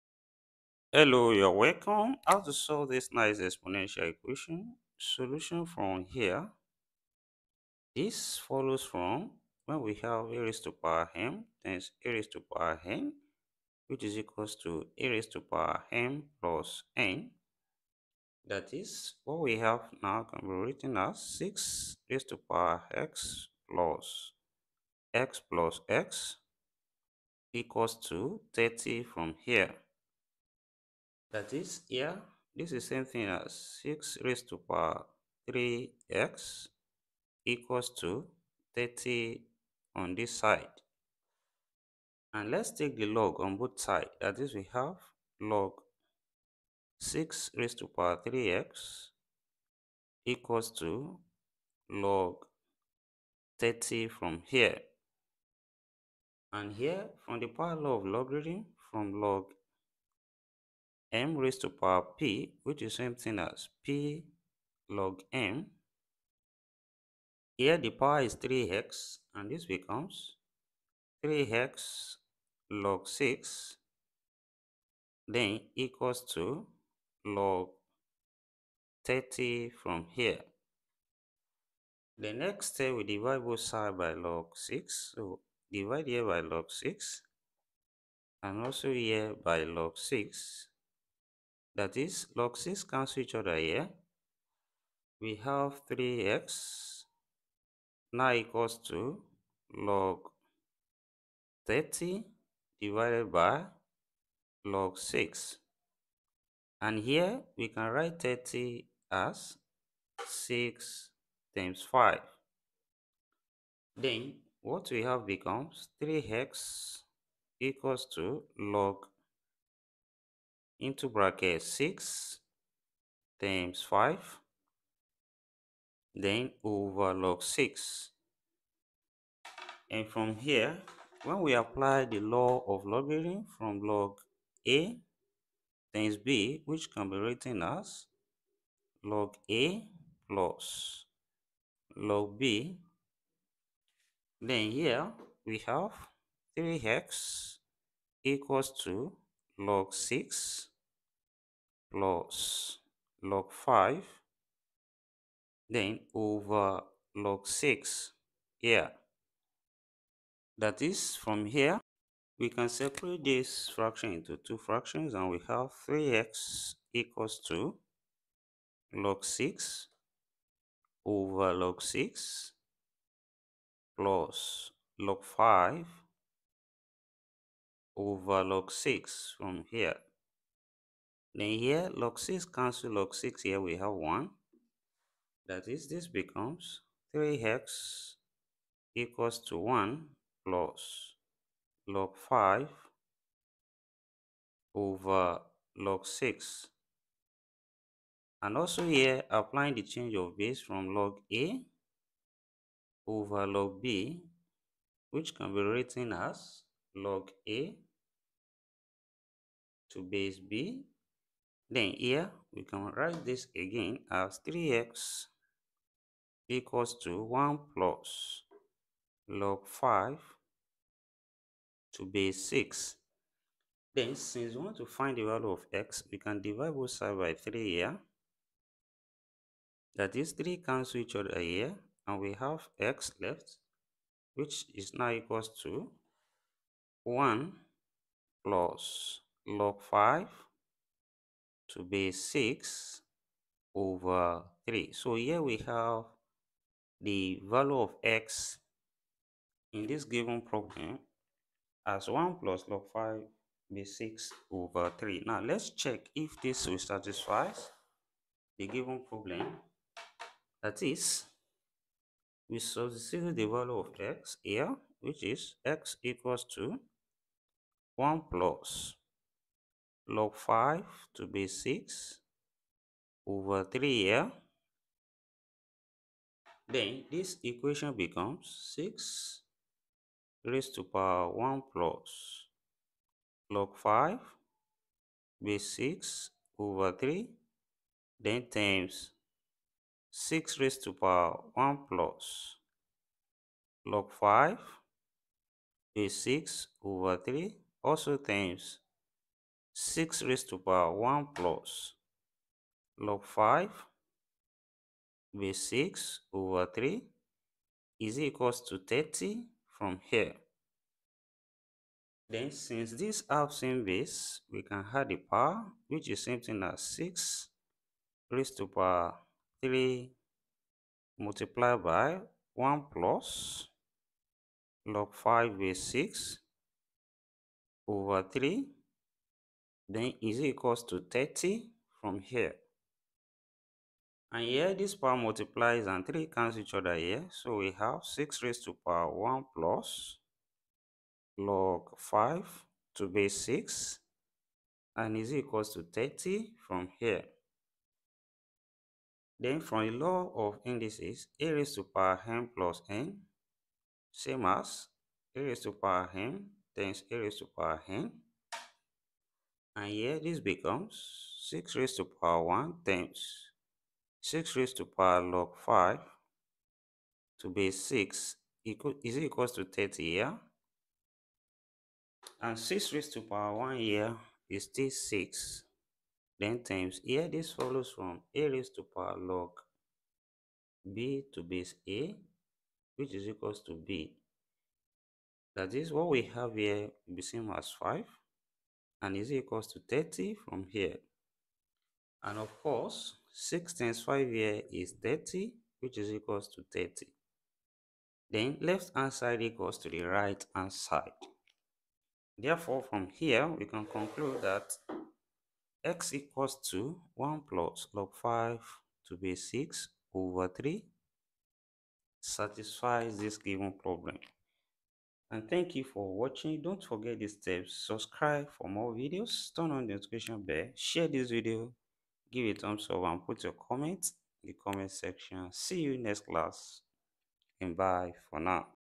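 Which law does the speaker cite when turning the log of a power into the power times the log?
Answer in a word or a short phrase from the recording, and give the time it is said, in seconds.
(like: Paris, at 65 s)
power law, at 57 s.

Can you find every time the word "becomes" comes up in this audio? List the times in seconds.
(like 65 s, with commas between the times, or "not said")
69 s, 115 s, 186 s, 277 s, 360 s.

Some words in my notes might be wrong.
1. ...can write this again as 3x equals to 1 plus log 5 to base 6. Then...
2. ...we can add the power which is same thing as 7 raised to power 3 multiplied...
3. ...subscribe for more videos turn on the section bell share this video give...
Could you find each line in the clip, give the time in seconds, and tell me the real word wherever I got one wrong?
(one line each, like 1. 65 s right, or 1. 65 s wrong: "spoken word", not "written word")
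1. 212 s right
2. 314 s wrong: "6", not "7"
3. 417 s wrong: "notification", not "section".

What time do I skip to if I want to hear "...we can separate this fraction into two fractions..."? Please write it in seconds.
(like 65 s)
162 s.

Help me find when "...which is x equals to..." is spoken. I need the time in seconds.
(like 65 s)
264 s.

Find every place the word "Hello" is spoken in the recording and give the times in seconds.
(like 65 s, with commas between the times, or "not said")
0 s.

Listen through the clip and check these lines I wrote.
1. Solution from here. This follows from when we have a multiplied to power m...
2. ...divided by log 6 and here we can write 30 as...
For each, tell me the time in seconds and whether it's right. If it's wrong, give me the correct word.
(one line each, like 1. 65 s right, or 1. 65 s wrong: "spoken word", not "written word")
1. 4 s wrong: "raised", not "multiplied"
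2. 102 s right.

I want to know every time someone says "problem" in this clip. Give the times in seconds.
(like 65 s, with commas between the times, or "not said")
250 s, 259 s, 413 s.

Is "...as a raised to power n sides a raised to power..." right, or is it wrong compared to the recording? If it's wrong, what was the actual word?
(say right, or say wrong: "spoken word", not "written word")
wrong: "times", not "sides".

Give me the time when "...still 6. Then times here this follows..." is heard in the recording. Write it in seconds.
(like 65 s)
374 s.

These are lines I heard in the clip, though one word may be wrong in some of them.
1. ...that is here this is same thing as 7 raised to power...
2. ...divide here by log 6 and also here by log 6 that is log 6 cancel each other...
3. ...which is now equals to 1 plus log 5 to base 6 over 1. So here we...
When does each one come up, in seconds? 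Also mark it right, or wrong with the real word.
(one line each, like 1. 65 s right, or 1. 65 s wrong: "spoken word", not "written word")
1. 31 s wrong: "6", not "7"
2. 85 s right
3. 234 s wrong: "3", not "1".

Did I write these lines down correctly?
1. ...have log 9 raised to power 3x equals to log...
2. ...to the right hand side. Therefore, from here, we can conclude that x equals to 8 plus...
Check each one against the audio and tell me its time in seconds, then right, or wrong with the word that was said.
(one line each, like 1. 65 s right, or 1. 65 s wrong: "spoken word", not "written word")
1. 44 s wrong: "6", not "9"
2. 399 s wrong: "1", not "8".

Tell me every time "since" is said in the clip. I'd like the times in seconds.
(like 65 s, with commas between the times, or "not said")
224 s, 312 s.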